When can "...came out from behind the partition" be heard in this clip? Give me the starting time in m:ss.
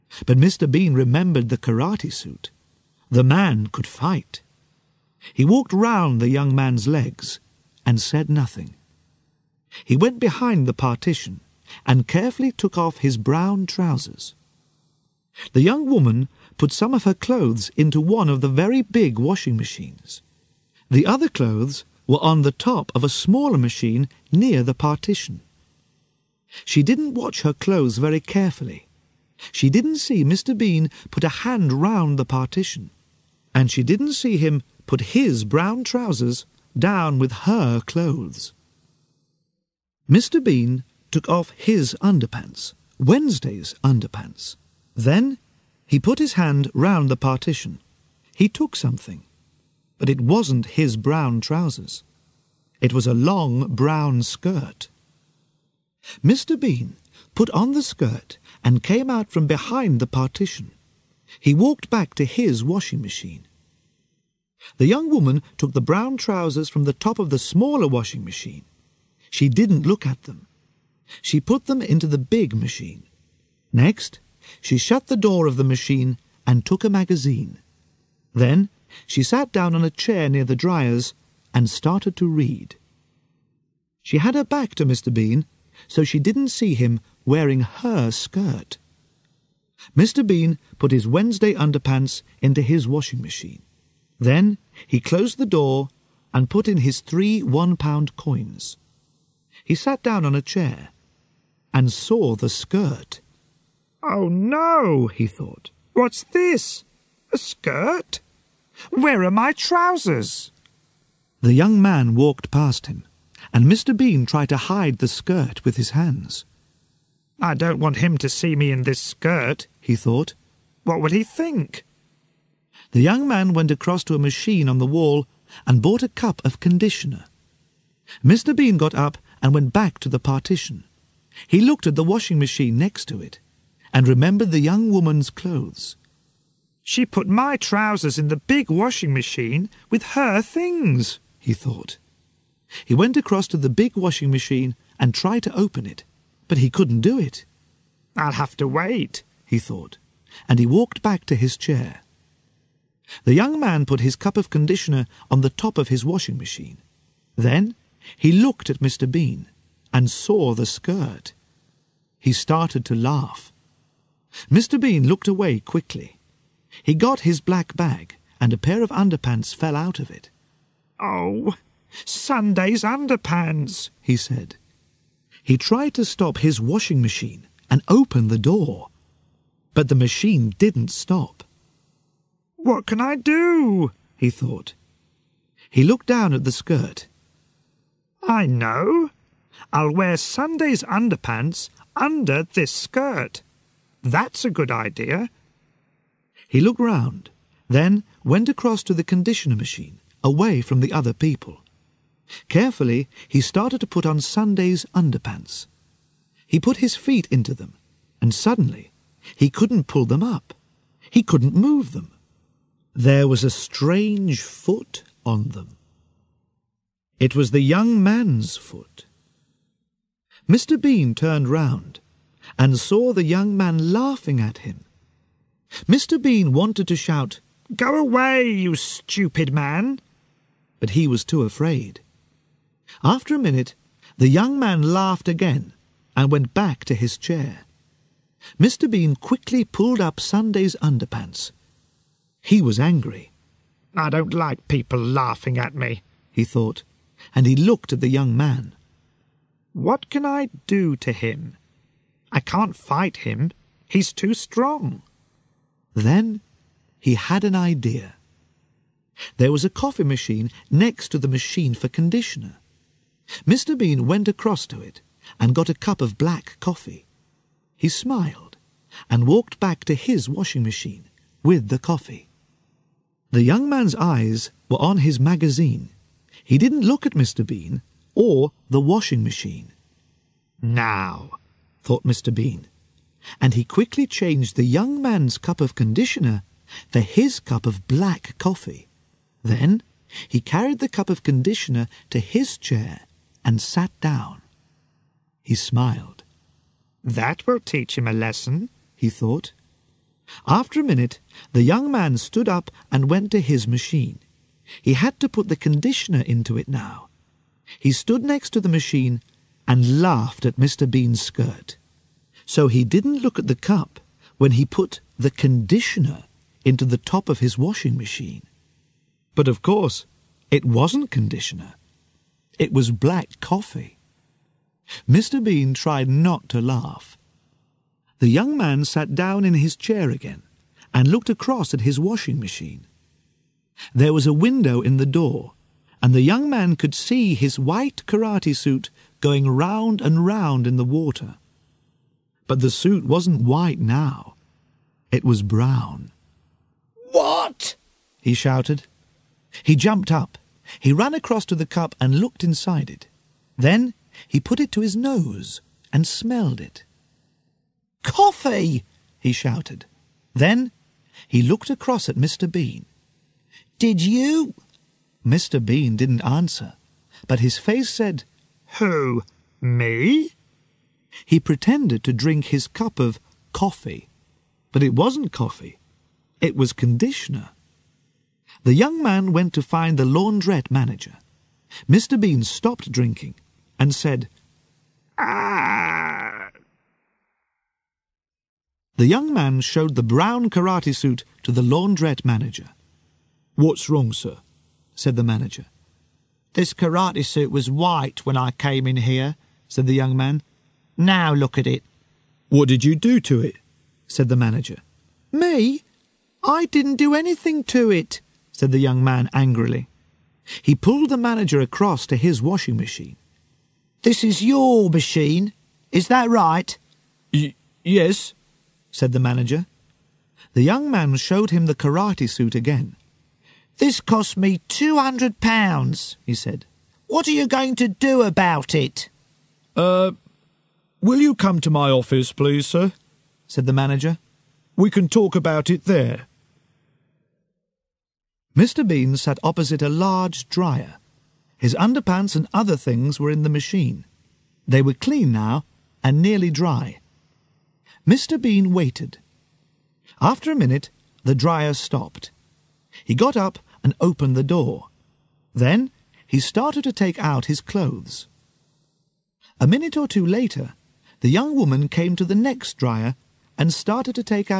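0:58.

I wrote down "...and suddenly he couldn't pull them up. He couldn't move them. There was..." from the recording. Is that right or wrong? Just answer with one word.
right.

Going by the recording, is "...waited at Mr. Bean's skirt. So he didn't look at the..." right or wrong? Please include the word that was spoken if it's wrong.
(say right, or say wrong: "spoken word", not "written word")
wrong: "laughed", not "waited".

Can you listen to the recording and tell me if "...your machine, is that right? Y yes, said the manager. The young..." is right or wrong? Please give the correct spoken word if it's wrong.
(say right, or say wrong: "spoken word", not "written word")
right.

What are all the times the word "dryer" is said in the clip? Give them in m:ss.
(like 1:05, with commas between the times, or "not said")
1:20, 7:20, 7:31, 7:42.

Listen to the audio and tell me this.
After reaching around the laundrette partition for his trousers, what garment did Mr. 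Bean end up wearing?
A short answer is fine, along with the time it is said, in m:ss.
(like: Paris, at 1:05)
long brown skirt, at 0:53.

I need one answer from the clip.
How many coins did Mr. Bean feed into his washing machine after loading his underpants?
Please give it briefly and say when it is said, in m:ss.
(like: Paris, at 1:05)
3, at 1:37.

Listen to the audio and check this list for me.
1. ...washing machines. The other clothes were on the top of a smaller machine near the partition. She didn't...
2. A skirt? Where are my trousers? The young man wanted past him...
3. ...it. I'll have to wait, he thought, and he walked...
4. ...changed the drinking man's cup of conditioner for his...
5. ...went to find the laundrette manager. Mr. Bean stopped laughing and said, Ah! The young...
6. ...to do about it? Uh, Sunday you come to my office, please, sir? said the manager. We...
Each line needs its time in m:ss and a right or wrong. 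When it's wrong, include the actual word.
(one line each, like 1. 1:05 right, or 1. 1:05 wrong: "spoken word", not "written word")
1. 0:19 right
2. 1:47 wrong: "walked", not "wanted"
3. 2:27 right
4. 4:44 wrong: "young", not "drinking"
5. 6:19 wrong: "drinking", not "laughing"
6. 7:07 wrong: "Will", not "Sunday".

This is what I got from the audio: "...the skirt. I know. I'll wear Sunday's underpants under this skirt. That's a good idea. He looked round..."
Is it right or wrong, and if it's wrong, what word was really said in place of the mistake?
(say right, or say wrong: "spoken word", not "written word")
right.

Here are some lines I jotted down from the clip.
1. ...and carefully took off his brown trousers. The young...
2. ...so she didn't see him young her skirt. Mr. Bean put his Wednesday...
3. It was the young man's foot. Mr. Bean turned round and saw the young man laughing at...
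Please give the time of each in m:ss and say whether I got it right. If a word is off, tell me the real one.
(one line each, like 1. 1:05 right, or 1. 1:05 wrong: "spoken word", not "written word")
1. 0:11 right
2. 1:25 wrong: "wearing", not "young"
3. 3:37 right.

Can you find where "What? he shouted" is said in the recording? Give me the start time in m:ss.
5:47.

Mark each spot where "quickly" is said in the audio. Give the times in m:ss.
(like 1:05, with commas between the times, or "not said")
2:45, 3:59, 4:43.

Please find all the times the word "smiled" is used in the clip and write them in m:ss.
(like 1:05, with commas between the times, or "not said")
4:27, 4:55.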